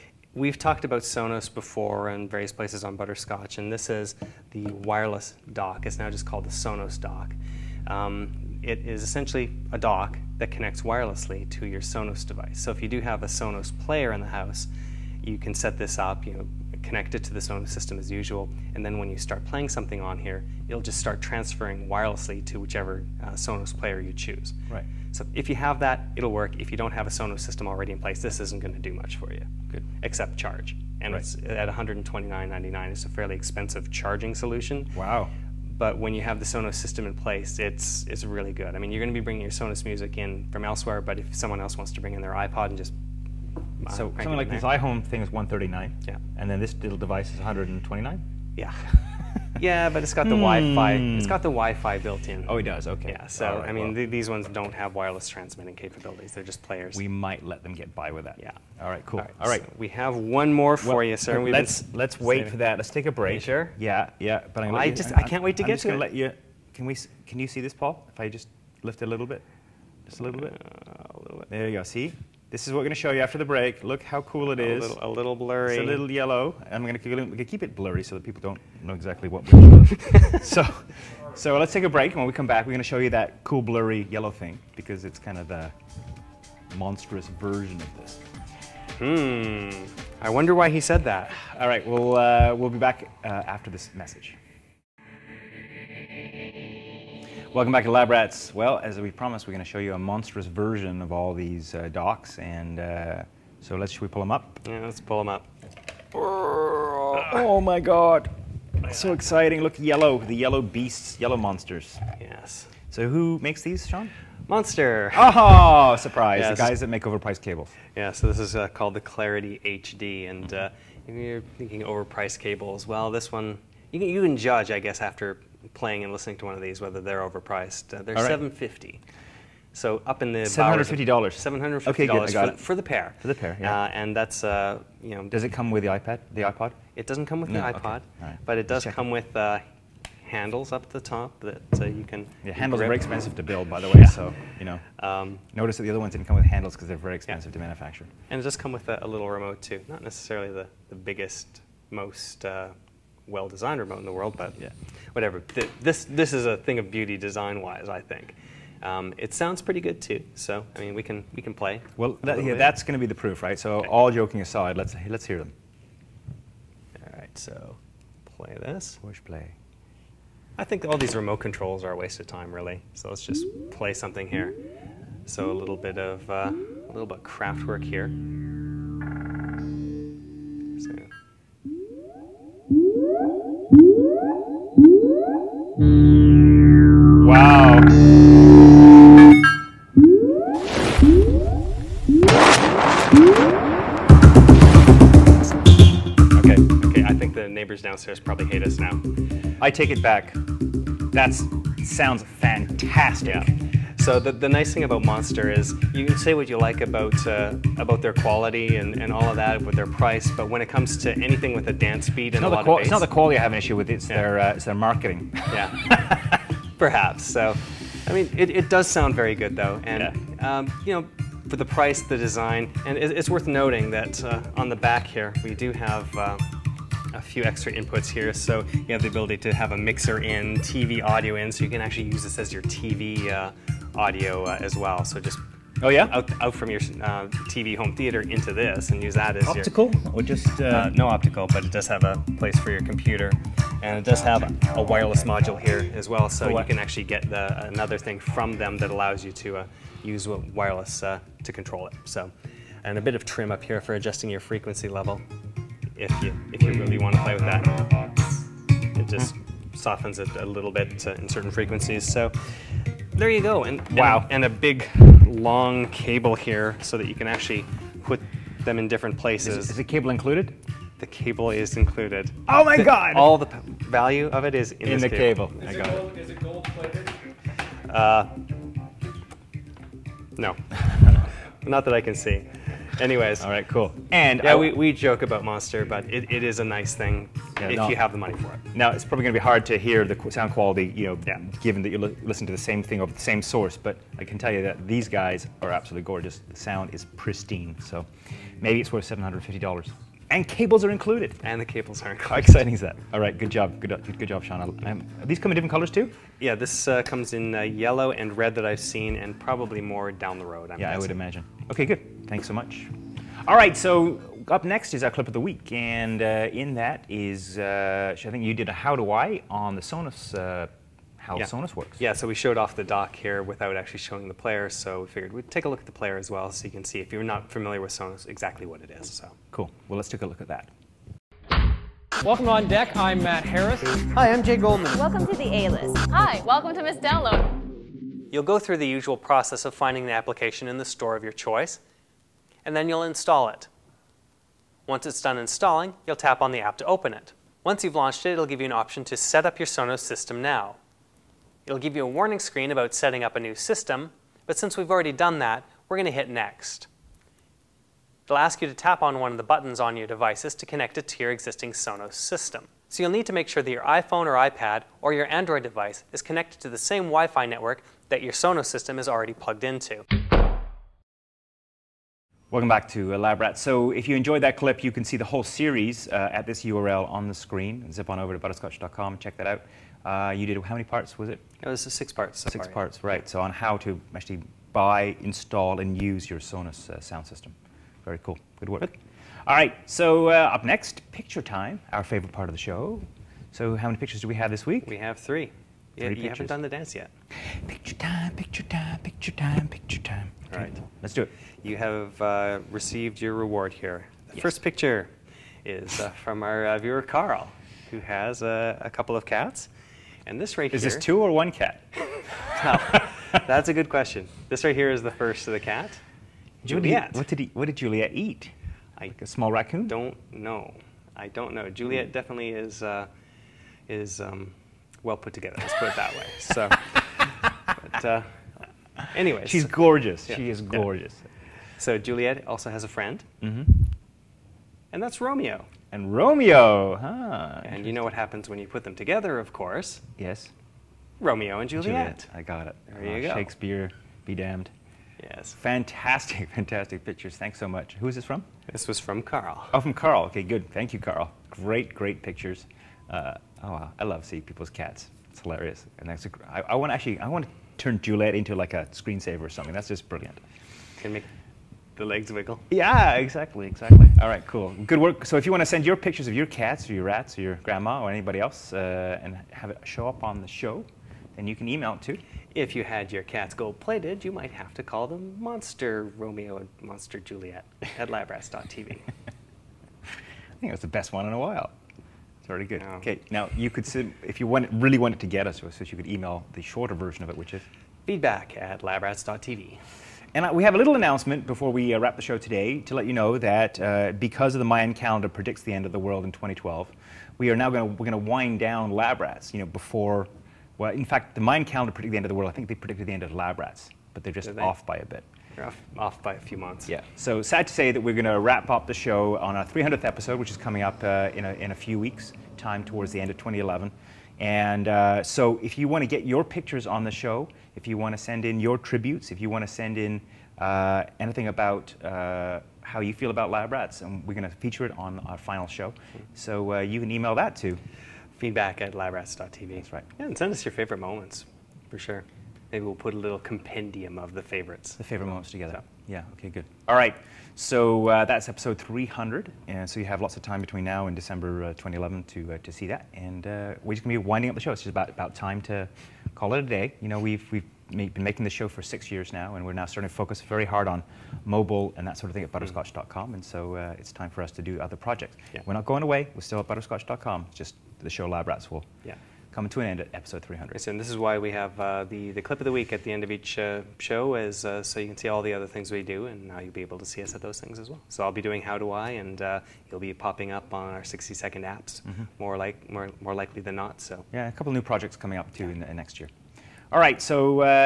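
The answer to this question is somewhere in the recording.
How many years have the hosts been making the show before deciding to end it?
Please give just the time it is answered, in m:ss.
9:08.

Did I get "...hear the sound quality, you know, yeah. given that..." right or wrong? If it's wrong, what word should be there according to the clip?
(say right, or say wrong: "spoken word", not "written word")
right.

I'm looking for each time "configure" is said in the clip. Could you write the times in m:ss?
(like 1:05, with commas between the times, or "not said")
not said.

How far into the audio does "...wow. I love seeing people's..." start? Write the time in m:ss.
7:33.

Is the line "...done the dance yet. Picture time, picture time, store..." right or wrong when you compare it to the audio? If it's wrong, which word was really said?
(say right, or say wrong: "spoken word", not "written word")
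wrong: "picture", not "store".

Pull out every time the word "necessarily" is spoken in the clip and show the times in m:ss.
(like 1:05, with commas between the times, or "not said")
2:30.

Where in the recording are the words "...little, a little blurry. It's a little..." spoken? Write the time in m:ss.
1:14.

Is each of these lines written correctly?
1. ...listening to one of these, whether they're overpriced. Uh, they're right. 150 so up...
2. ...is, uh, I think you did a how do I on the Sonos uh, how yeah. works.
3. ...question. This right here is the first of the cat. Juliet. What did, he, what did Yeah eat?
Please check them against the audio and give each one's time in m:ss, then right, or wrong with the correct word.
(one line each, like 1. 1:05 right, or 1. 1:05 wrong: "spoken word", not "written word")
1. 2:06 wrong: "750", not "150"
2. 5:17 right
3. 6:53 wrong: "Juliet", not "Yeah".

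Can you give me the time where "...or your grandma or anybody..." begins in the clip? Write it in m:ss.
7:47.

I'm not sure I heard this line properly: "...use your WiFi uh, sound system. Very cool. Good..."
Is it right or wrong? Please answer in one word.
wrong.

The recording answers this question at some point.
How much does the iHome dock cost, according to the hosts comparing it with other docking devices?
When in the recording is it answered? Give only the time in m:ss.
0:45.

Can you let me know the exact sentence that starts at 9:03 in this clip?
And uh, we're just going to be winding up the show.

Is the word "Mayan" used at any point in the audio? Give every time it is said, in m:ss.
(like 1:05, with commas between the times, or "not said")
8:14, 8:21.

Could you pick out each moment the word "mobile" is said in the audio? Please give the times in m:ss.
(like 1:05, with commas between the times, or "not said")
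9:11.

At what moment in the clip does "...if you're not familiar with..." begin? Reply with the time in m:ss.
5:26.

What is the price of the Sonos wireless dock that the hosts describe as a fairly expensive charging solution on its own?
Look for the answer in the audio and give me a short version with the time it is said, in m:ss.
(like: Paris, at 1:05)
$99, at 0:31.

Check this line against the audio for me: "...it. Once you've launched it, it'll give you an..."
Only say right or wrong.
right.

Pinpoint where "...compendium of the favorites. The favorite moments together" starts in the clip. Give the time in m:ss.
8:53.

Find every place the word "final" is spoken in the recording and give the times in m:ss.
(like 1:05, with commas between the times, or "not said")
8:45.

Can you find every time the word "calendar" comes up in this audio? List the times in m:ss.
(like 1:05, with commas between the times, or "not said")
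8:14, 8:21.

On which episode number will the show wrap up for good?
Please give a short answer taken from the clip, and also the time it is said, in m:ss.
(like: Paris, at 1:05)
300th, at 8:29.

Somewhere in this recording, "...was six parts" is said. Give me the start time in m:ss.
6:21.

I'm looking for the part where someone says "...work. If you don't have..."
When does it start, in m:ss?
0:26.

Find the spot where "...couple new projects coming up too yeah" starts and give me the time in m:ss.
9:34.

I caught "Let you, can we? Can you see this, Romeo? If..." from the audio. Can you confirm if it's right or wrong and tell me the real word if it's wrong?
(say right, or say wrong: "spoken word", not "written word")
wrong: "Paul", not "Romeo".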